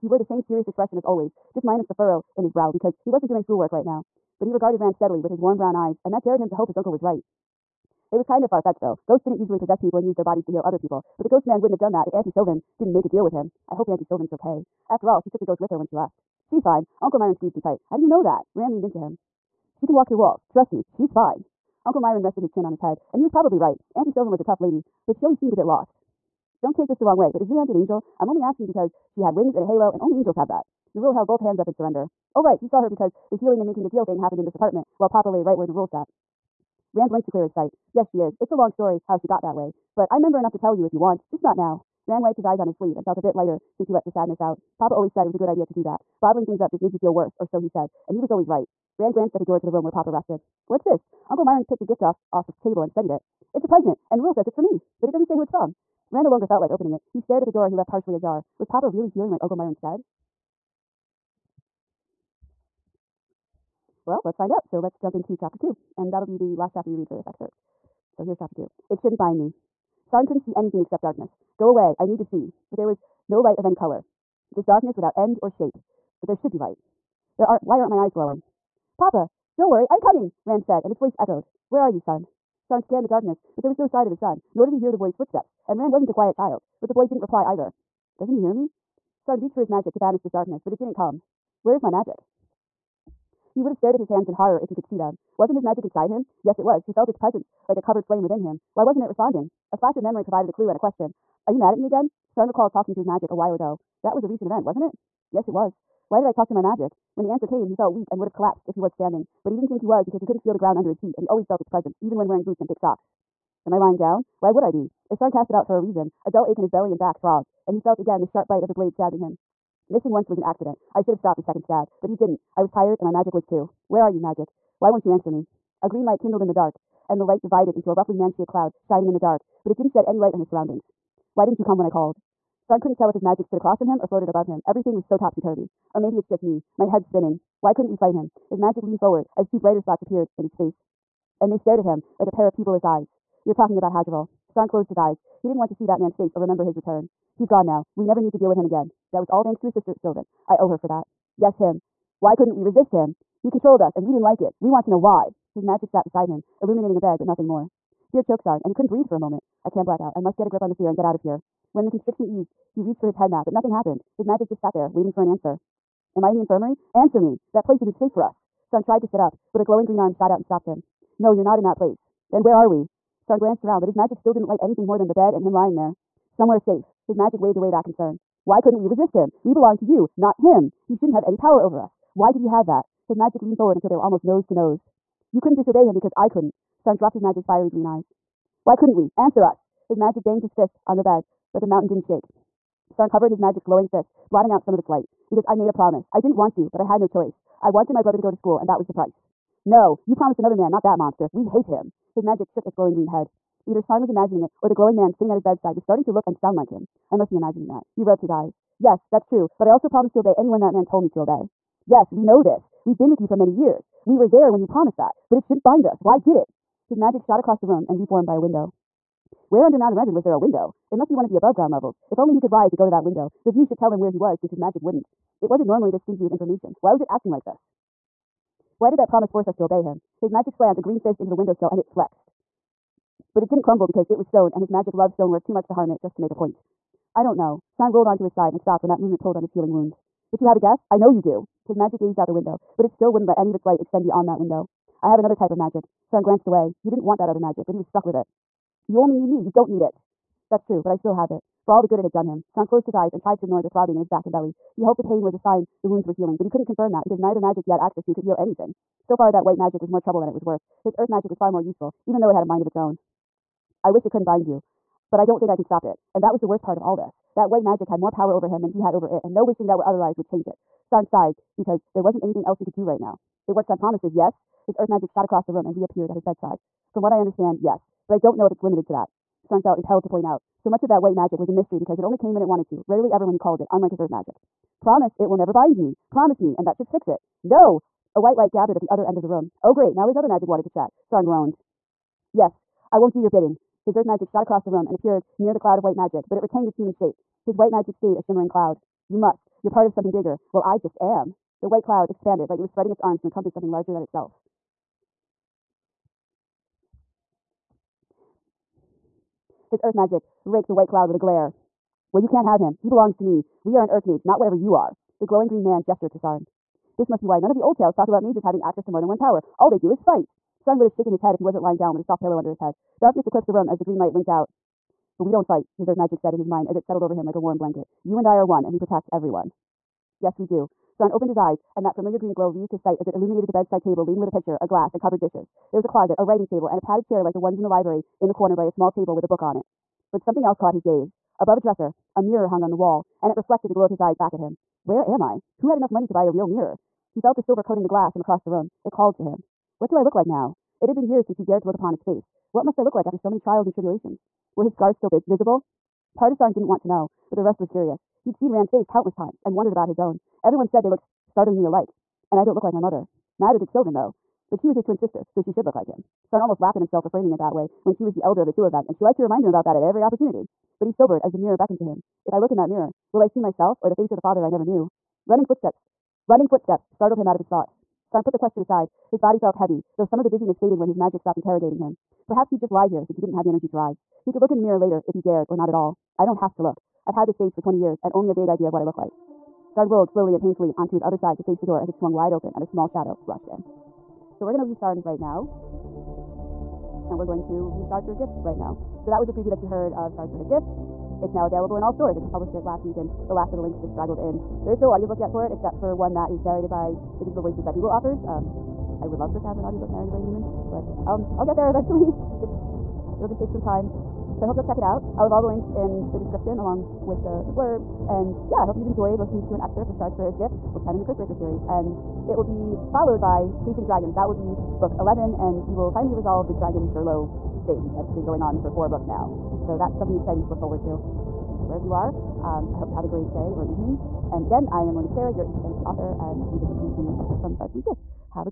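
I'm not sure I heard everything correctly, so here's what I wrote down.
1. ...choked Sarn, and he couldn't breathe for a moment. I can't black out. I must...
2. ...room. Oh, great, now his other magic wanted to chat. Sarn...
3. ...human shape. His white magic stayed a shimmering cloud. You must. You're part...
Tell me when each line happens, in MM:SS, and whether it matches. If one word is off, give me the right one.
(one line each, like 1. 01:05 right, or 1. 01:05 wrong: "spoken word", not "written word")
1. 02:38 right
2. 04:49 right
3. 04:56 right.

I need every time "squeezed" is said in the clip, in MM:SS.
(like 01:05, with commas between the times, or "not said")
00:17.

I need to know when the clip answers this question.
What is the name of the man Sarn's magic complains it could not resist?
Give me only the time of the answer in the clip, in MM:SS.
02:23.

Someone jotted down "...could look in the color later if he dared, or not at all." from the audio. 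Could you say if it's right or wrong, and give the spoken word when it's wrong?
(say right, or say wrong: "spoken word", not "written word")
wrong: "mirror", not "color".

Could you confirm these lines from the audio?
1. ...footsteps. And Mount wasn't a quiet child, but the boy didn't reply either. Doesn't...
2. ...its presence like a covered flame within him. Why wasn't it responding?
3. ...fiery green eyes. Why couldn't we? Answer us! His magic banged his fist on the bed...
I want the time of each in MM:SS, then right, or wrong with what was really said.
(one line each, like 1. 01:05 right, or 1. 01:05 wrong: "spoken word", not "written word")
1. 01:25 wrong: "Ran", not "Mount"
2. 01:37 right
3. 03:07 right.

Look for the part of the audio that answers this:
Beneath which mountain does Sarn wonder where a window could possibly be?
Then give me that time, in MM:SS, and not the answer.
03:39.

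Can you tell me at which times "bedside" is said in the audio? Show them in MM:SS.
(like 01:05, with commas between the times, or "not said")
03:25, 04:36, 05:33.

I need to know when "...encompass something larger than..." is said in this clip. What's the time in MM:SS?
05:03.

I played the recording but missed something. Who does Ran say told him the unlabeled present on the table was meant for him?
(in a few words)
Rule.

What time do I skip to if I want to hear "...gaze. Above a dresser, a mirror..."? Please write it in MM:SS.
05:40.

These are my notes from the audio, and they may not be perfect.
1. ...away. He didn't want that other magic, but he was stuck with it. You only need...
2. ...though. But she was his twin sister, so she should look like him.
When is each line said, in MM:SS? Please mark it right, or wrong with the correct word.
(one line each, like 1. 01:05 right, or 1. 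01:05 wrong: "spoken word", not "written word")
1. 04:06 right
2. 06:03 right.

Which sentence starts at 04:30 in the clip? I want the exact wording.
Sarn sighed because there wasn't anything else he could do right now.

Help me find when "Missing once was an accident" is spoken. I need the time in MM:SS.
01:59.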